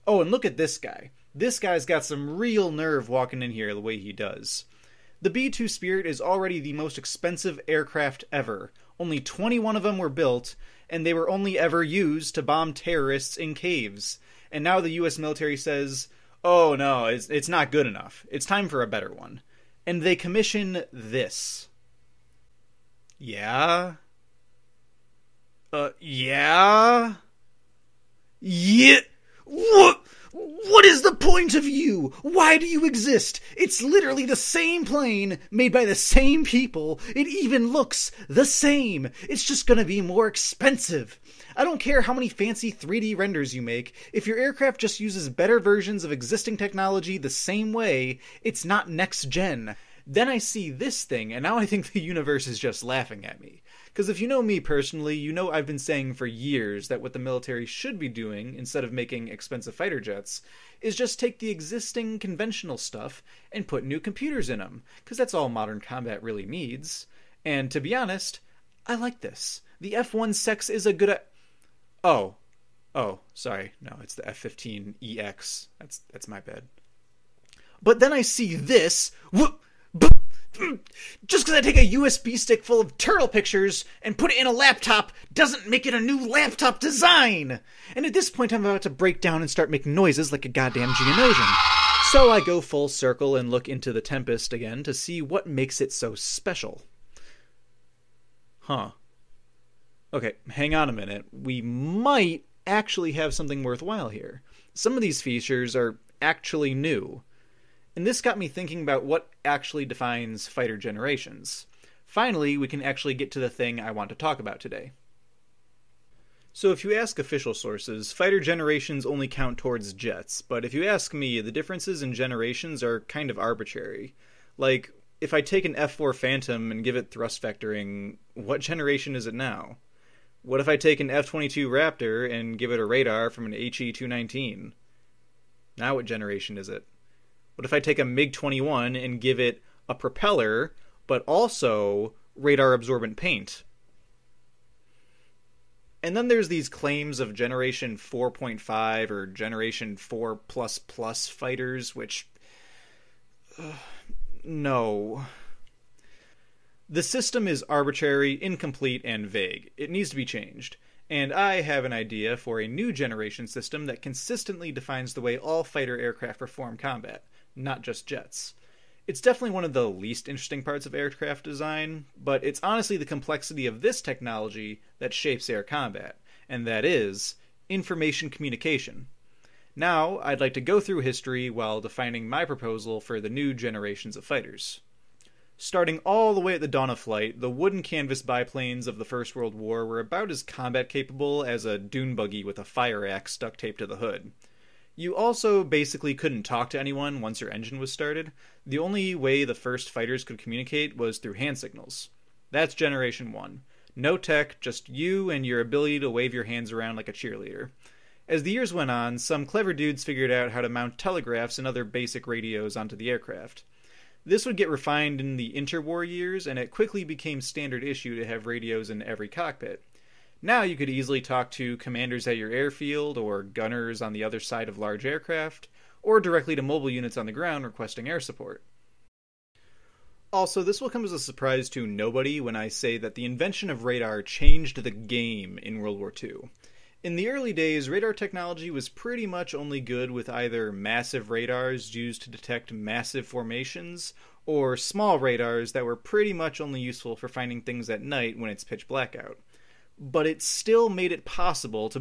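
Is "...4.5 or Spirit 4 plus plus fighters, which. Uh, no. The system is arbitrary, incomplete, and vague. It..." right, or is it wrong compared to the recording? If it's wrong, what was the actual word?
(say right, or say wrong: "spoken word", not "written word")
wrong: "Generation", not "Spirit".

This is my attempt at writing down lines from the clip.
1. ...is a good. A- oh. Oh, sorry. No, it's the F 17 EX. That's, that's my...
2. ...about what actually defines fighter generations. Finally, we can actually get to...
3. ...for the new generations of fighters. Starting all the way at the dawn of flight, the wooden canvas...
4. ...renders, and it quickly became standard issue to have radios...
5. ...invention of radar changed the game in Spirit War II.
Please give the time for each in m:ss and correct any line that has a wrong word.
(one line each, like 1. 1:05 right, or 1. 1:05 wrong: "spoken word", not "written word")
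1. 1:10 wrong: "15", not "17"
2. 1:48 right
3. 3:02 right
4. 3:36 wrong: "years", not "renders"
5. 3:53 wrong: "World", not "Spirit".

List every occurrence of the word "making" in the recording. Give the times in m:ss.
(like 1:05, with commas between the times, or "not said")
0:58, 1:29.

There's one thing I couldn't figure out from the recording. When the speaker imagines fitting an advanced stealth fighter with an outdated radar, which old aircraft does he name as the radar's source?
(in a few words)
HE 219.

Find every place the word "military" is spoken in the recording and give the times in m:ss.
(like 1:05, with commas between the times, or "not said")
0:15, 0:57.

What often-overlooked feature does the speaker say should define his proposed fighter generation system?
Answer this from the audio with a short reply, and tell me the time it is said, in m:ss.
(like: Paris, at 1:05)
Information communication, at 2:57.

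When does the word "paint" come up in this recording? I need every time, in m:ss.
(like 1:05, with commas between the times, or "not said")
2:23.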